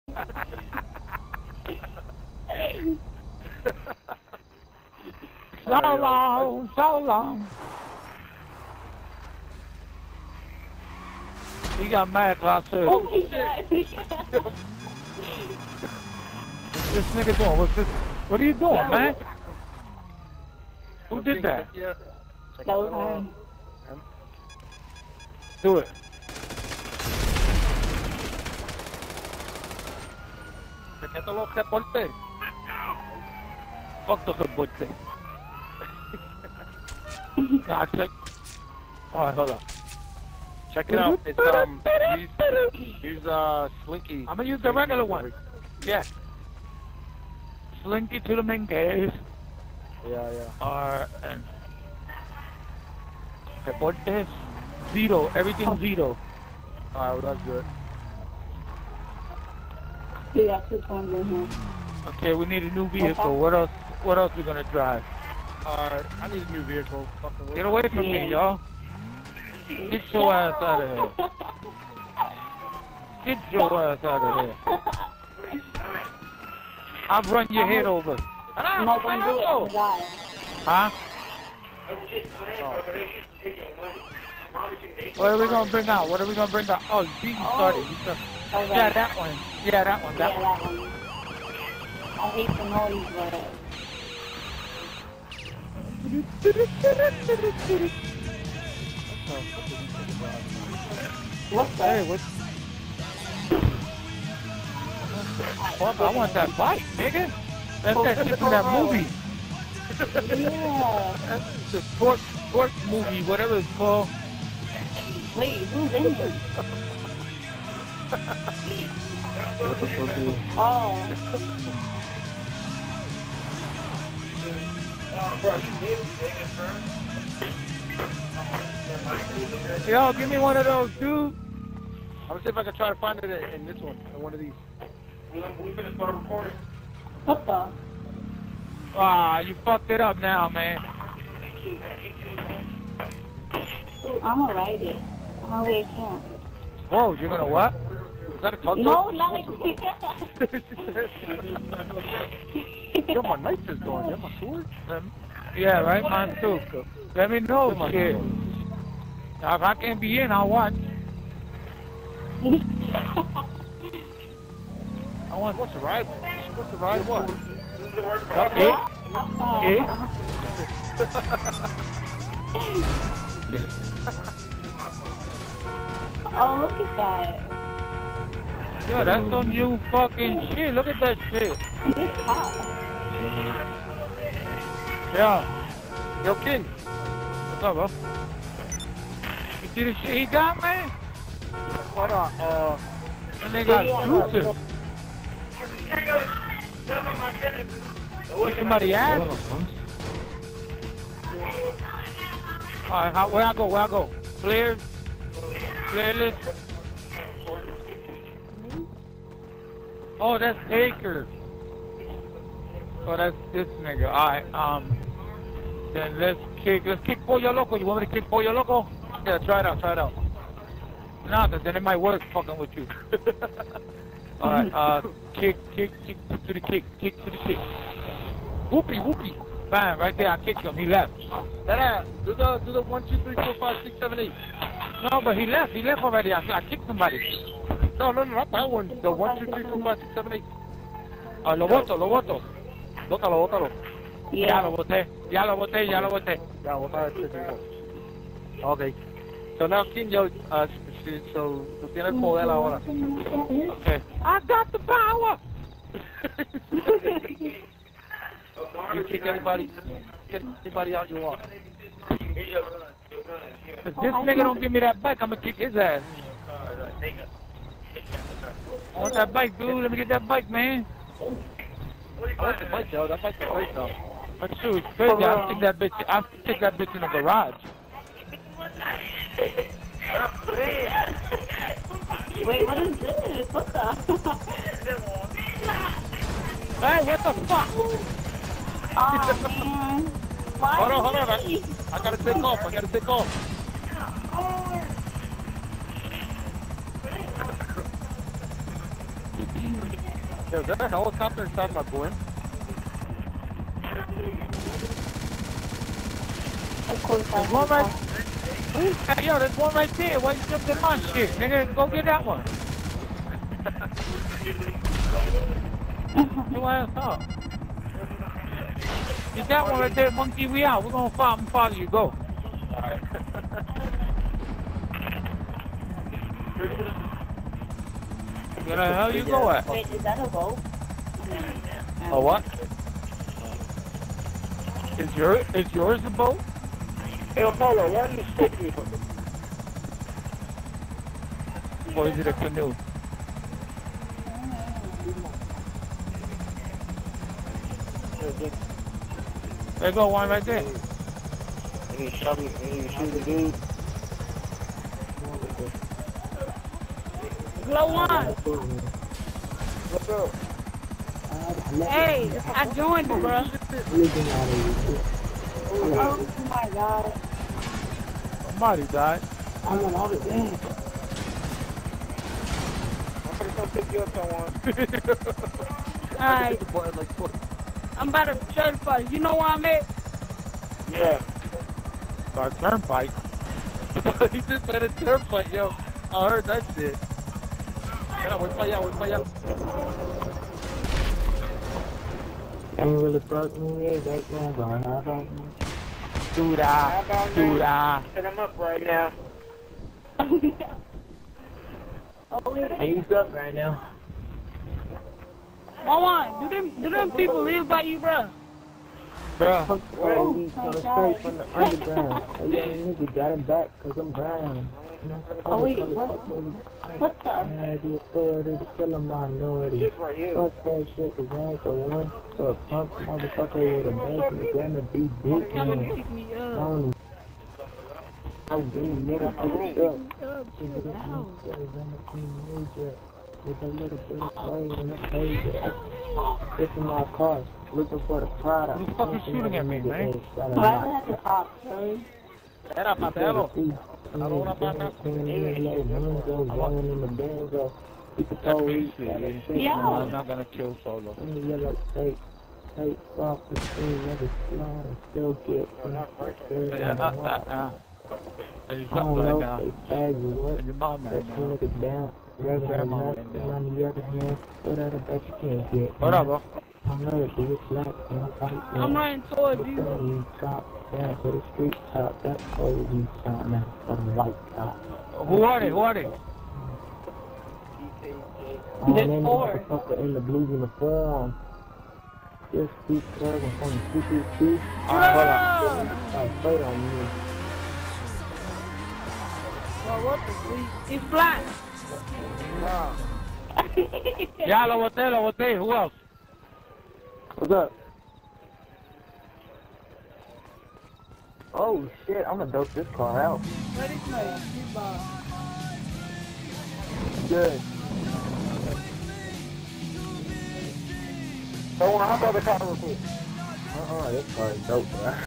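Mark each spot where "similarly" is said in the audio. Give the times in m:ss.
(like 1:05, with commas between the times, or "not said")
not said.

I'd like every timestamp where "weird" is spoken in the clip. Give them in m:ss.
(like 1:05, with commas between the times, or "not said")
6:33.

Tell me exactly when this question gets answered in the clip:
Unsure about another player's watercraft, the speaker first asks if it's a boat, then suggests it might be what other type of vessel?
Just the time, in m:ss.
5:42.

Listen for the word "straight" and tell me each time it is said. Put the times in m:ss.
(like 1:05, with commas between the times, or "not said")
6:51.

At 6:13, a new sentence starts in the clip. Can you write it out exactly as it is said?
I'm about to come pick you to certify.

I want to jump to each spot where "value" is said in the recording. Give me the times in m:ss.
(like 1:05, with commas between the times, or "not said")
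not said.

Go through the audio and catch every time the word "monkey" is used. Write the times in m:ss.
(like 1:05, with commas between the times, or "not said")
5:20.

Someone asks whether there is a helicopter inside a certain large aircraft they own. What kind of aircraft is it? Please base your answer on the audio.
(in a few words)
Blimp.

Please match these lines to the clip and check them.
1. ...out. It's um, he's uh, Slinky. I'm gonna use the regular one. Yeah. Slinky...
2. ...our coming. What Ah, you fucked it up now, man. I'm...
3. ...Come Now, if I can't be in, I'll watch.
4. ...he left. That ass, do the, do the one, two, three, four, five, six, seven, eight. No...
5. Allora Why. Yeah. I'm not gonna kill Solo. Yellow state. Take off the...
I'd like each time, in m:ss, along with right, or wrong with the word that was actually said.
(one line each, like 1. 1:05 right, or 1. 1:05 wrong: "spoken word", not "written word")
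1. 0:40 right
2. 2:15 wrong: "recording", not "coming"
3. 2:37 right
4. 3:50 right
5. 7:24 wrong: "Patelo", not "Why".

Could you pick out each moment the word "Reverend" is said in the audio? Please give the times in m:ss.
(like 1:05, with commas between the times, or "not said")
7:42.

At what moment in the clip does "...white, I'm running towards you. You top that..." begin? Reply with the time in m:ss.
7:48.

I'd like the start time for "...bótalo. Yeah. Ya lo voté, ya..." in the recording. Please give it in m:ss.
4:03.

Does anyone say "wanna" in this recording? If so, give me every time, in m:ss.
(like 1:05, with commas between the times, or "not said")
8:31.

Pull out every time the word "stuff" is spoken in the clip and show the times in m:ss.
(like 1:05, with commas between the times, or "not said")
7:09.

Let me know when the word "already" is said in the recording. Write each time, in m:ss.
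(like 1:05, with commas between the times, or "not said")
2:25, 3:56.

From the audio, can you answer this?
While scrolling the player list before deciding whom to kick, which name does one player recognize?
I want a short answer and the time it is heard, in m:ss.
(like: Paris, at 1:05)
Taker, at 3:30.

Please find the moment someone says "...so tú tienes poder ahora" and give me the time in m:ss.
4:11.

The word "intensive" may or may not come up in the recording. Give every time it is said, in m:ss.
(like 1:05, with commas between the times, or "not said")
not said.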